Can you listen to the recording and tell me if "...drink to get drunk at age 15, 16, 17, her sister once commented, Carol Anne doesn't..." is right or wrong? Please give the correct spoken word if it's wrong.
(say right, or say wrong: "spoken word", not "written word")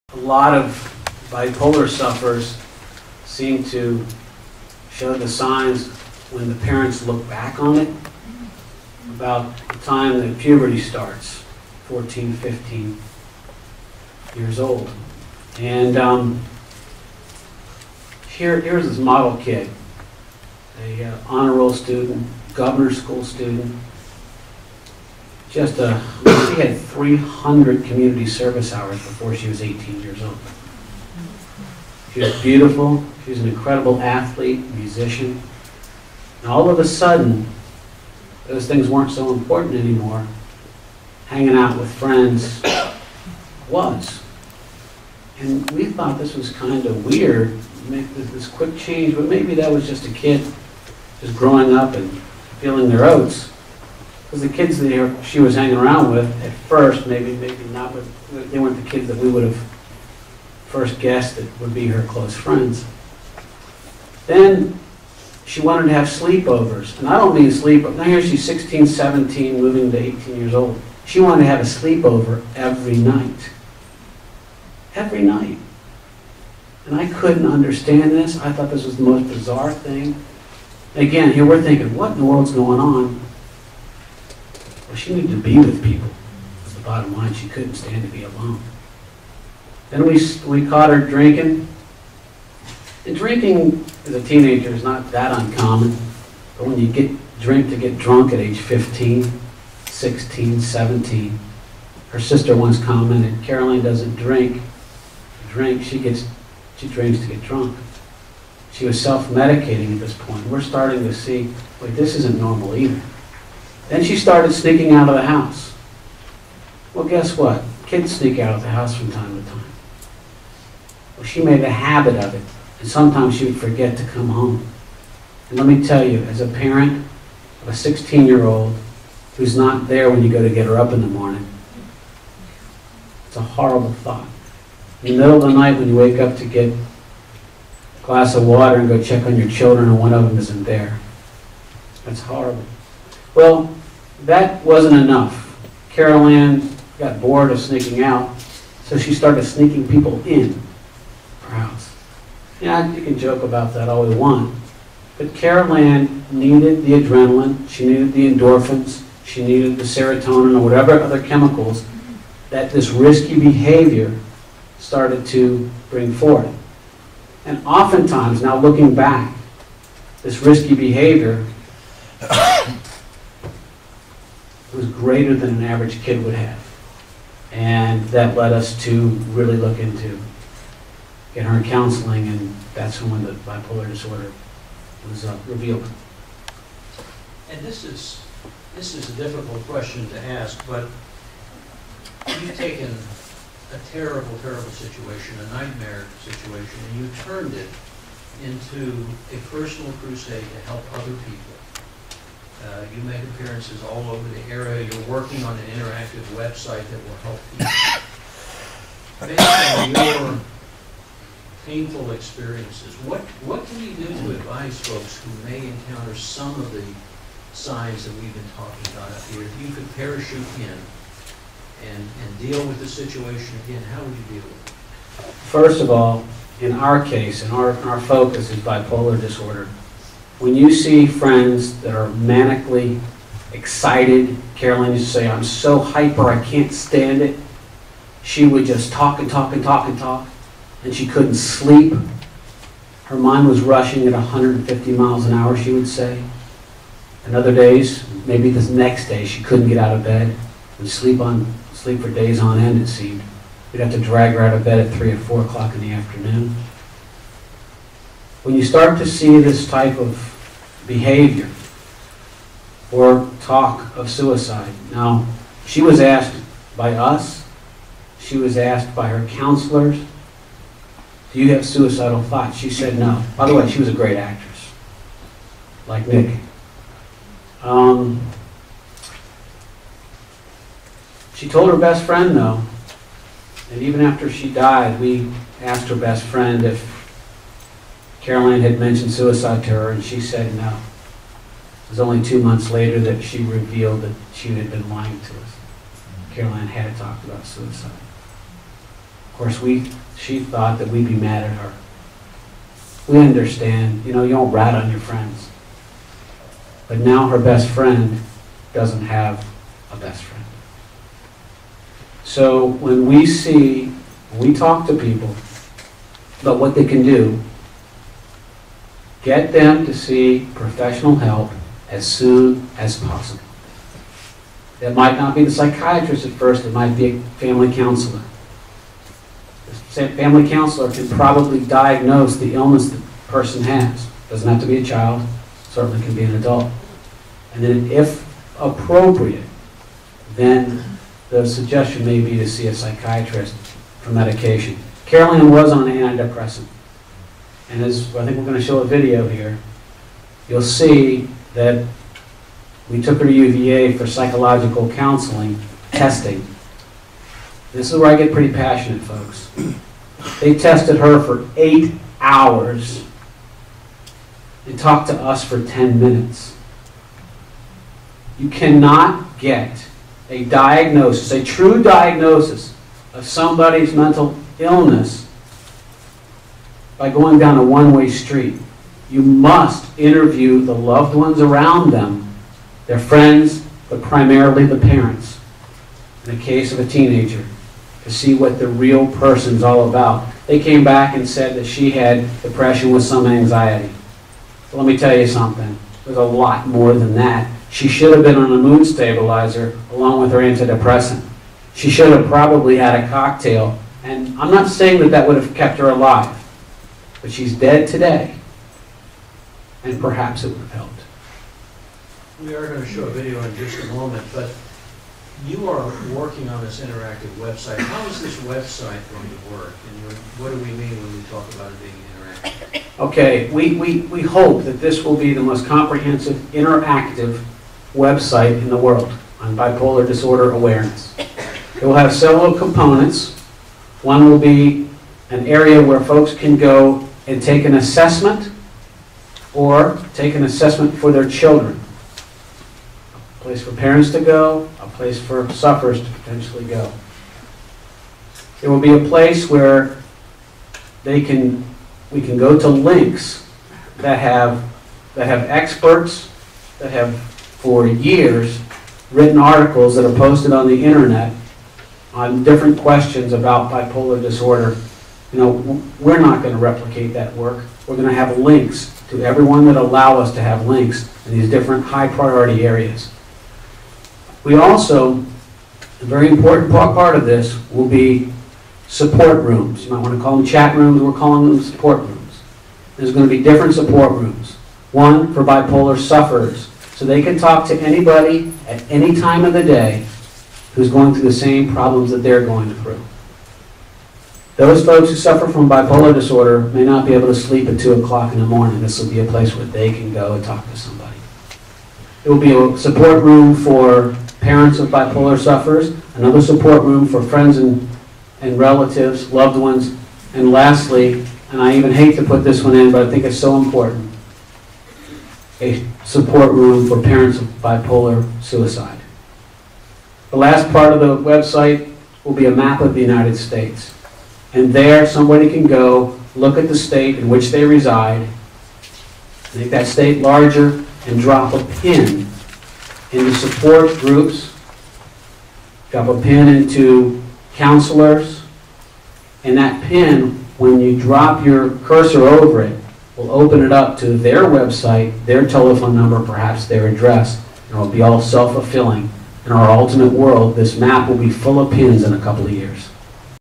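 right.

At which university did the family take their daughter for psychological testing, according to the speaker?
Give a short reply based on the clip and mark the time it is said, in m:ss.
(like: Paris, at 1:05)
UVA, at 5:53.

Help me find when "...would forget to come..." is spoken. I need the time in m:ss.
2:03.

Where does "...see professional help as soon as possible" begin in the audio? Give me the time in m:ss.
5:19.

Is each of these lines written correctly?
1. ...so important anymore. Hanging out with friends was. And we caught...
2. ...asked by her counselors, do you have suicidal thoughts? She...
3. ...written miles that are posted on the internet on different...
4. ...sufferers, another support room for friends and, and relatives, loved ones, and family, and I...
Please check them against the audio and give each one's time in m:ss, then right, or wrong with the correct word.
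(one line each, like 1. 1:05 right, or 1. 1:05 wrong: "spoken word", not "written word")
1. 0:39 wrong: "thought", not "caught"
2. 4:28 right
3. 7:39 wrong: "articles", not "miles"
4. 8:25 wrong: "lastly", not "family".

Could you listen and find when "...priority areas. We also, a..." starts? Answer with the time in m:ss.
7:52.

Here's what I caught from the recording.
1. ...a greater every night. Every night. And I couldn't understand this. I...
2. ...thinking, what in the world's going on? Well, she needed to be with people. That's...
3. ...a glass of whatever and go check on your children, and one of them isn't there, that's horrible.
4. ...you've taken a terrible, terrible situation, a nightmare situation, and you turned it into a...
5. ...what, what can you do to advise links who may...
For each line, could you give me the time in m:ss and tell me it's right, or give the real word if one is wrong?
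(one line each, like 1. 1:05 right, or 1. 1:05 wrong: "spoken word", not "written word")
1. 1:11 wrong: "sleepover", not "greater"
2. 1:21 right
3. 2:16 wrong: "water", not "whatever"
4. 3:12 right
5. 3:32 wrong: "folks", not "links".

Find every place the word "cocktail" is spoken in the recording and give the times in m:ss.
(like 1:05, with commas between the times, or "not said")
6:43.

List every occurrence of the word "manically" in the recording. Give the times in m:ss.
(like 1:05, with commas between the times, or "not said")
3:52.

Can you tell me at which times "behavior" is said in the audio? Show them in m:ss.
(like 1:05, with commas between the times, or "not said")
2:43, 2:50, 4:20.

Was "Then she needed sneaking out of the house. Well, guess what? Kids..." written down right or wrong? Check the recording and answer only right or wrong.
wrong.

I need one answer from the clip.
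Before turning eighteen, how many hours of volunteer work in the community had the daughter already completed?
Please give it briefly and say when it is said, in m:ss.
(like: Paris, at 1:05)
300, at 0:26.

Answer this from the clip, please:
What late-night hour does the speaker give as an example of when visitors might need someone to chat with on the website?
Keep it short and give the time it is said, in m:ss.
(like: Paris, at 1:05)
2 o'clock in the morning, at 8:17.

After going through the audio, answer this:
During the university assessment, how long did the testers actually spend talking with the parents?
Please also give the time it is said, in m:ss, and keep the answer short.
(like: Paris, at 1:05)
10 minutes, at 6:05.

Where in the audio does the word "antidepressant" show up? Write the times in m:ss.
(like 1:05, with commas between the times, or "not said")
5:45, 6:40.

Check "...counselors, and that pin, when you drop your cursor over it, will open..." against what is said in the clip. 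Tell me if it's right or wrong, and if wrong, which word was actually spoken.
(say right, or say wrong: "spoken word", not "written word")
right.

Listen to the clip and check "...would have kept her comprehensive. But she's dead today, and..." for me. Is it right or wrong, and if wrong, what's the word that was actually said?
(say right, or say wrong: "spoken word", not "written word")
wrong: "alive", not "comprehensive".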